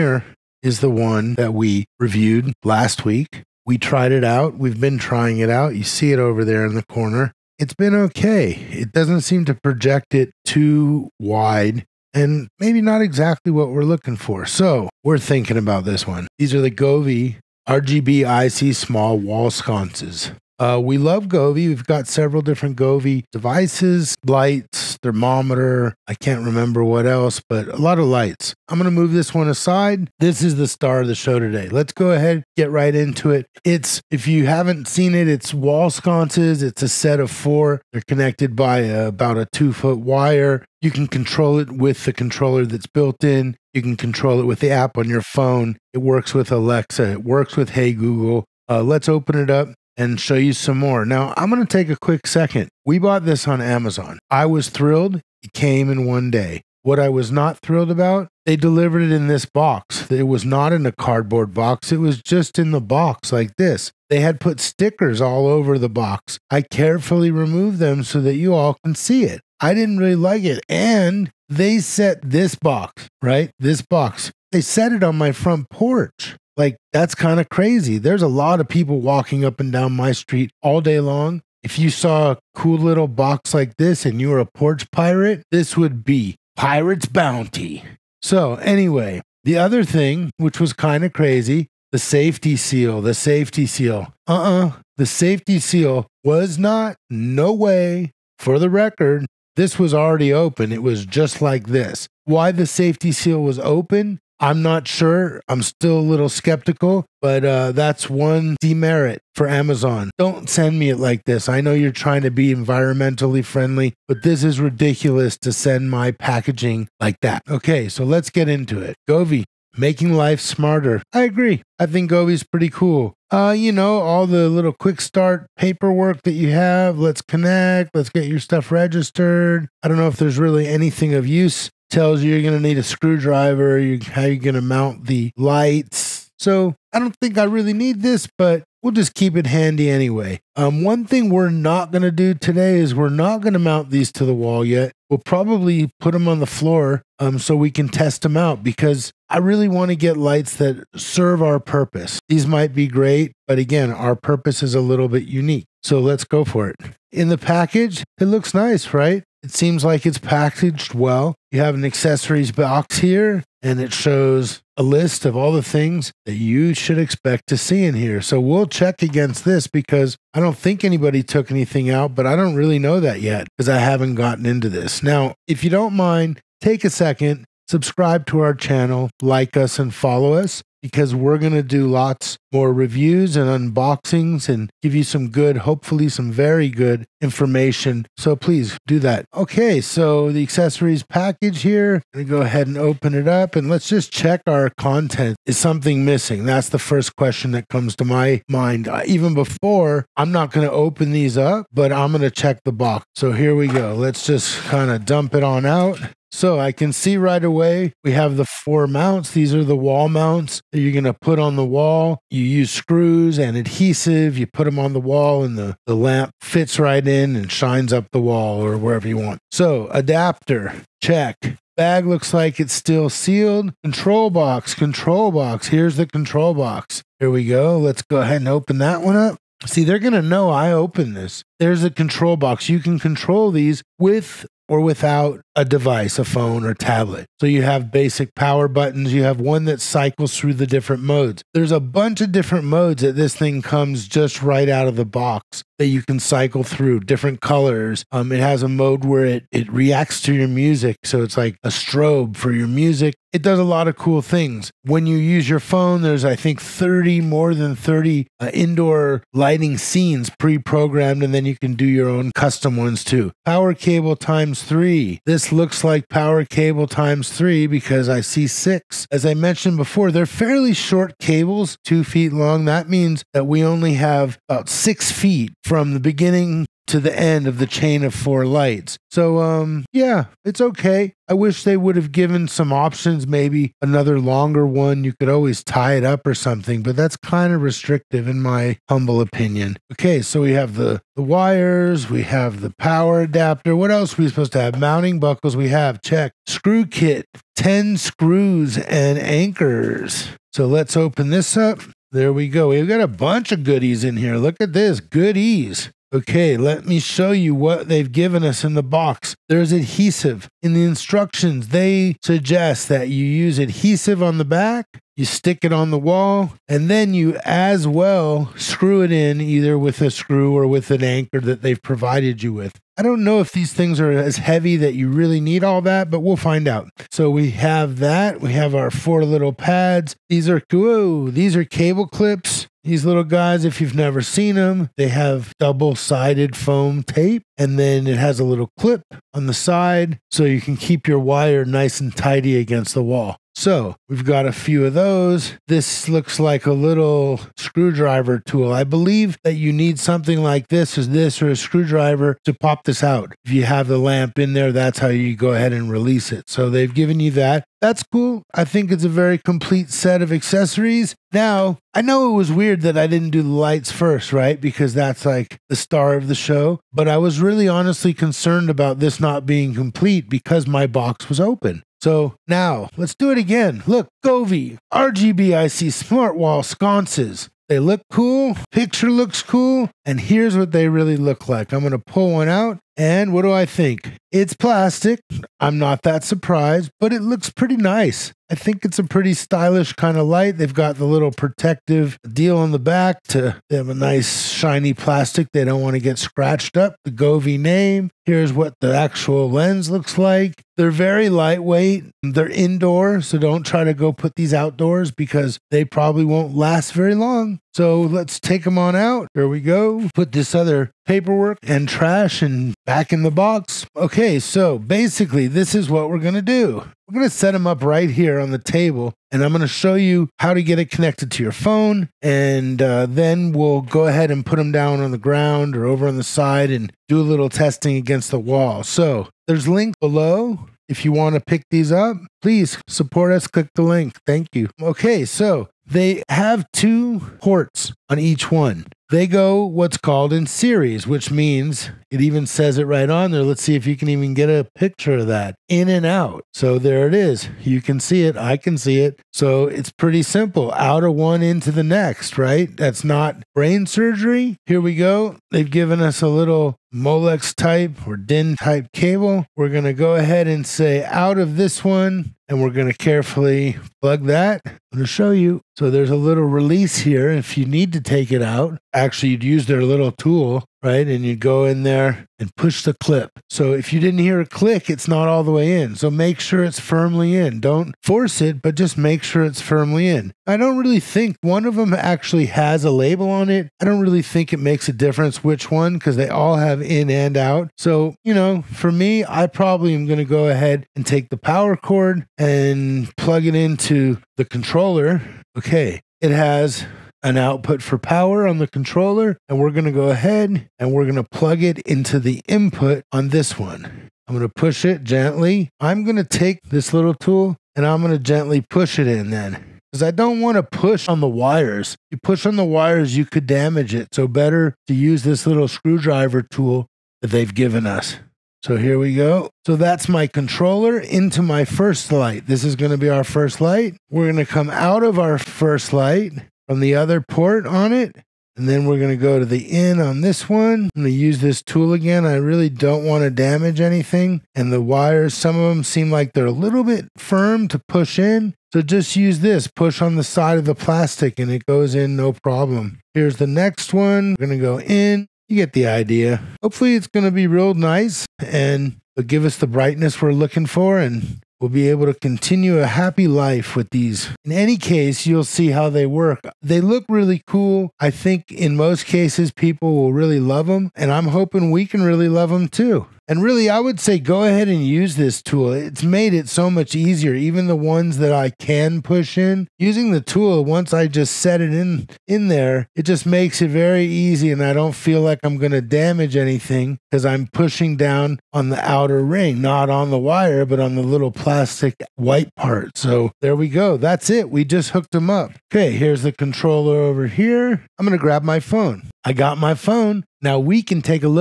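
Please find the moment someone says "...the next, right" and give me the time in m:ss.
7:31.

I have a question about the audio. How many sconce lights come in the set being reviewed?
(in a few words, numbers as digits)
4.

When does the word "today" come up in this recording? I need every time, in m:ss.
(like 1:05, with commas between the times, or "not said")
0:31, 2:22.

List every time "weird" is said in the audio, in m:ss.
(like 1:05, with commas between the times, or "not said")
6:02.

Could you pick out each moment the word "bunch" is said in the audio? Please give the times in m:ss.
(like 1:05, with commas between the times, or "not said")
4:01, 5:03.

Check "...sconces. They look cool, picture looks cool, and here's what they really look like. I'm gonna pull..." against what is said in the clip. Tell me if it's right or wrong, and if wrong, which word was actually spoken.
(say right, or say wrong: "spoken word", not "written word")
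right.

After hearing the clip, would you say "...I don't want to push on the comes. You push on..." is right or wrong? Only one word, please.
wrong.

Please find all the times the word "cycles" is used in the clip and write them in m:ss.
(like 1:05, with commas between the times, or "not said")
3:59, 4:06.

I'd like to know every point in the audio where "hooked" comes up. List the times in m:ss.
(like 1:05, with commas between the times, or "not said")
9:44.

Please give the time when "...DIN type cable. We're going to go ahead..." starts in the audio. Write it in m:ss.
7:38.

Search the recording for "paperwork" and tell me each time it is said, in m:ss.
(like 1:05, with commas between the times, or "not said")
2:05, 6:51.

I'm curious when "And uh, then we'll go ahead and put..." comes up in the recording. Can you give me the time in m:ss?
7:02.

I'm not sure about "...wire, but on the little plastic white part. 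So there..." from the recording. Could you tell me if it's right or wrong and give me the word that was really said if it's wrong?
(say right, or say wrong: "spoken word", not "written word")
right.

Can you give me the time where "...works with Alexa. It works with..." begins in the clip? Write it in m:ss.
0:45.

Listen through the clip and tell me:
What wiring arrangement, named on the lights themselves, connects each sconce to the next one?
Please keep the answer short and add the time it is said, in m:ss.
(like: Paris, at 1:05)
In series, at 7:20.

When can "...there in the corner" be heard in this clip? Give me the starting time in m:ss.
0:06.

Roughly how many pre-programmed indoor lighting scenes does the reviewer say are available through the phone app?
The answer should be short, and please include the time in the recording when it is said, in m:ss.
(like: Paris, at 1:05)
More than 30, at 4:17.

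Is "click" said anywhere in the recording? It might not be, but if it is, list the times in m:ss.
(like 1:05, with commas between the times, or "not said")
7:13, 7:54.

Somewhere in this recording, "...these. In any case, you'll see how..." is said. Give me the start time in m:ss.
9:13.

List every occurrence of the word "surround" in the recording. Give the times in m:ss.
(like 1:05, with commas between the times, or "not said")
not said.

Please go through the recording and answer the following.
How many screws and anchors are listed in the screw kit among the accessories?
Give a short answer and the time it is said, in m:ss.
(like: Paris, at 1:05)
10, at 4:57.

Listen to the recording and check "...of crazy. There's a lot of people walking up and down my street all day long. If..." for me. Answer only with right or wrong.
right.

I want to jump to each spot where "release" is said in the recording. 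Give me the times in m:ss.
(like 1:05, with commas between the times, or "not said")
5:55, 7:46.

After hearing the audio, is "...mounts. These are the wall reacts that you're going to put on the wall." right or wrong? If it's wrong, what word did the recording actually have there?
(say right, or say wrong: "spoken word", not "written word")
wrong: "mounts", not "reacts".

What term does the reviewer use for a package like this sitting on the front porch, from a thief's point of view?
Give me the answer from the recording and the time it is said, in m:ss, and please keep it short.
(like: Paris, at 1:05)
Pirate's Bounty, at 1:26.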